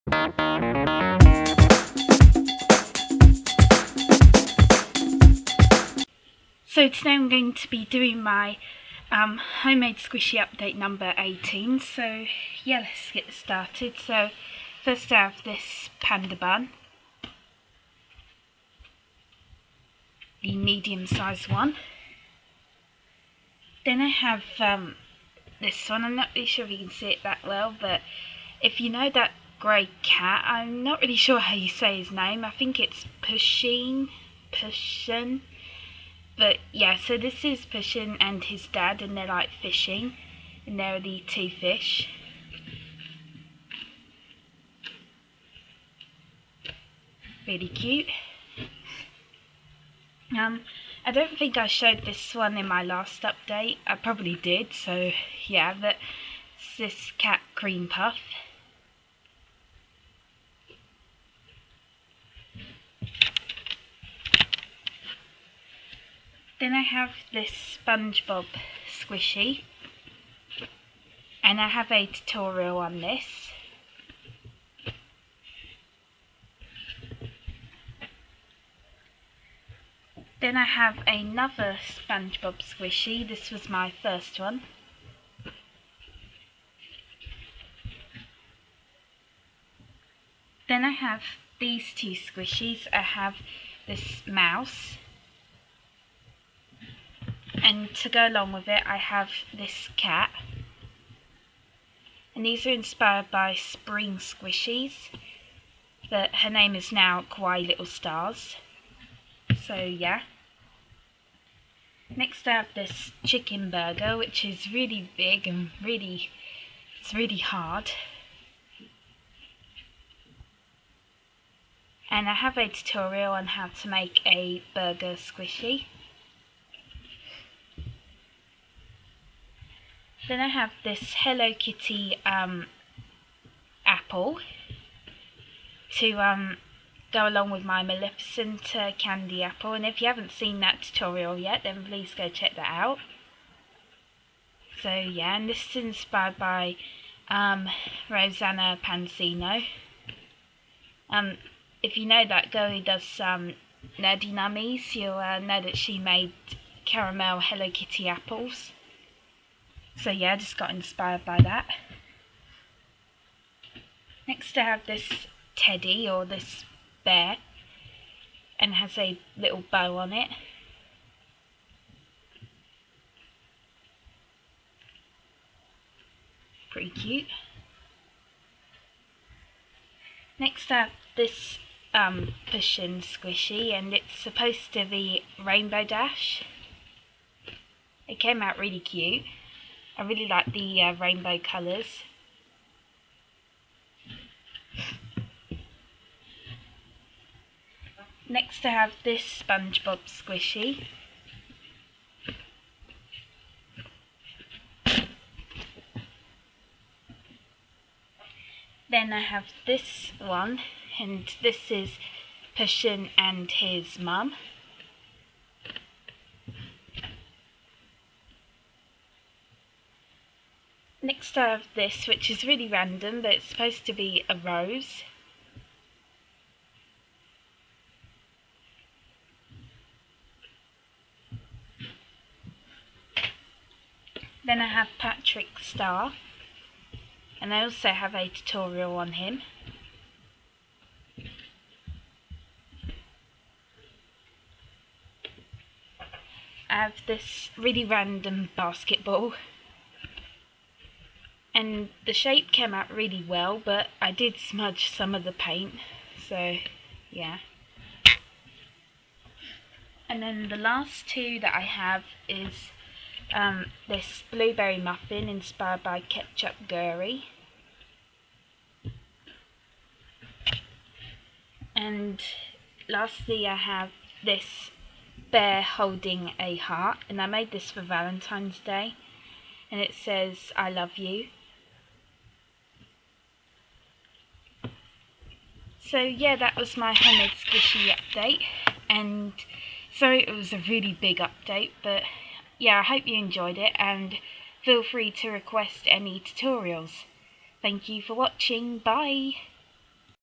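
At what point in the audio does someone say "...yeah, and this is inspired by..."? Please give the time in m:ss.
2:24.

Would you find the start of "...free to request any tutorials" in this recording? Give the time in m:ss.
4:54.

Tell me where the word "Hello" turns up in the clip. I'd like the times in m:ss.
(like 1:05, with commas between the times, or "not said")
2:11, 2:37.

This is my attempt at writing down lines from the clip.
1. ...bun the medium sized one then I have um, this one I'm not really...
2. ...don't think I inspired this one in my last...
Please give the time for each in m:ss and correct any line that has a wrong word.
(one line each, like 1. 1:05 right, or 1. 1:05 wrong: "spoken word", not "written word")
1. 0:16 right
2. 0:51 wrong: "showed", not "inspired".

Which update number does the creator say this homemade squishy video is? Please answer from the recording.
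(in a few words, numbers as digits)
18.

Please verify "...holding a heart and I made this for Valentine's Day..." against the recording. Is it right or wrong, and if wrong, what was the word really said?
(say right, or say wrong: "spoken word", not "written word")
right.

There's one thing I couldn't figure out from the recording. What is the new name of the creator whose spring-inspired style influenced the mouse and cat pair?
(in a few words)
Kawaii Little Stars.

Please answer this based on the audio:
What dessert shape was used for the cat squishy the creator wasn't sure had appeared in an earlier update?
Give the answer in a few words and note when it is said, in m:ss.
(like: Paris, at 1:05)
cream puff, at 0:57.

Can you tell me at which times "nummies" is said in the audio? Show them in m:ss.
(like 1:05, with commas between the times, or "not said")
2:34.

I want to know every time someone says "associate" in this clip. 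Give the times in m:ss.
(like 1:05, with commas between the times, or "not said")
not said.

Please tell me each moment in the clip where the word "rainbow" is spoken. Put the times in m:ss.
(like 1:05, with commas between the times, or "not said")
3:05, 3:10.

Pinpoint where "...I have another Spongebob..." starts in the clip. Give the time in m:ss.
1:20.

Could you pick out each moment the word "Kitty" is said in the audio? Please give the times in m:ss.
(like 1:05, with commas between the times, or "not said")
2:11, 2:37.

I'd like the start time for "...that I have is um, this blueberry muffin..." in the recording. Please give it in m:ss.
4:21.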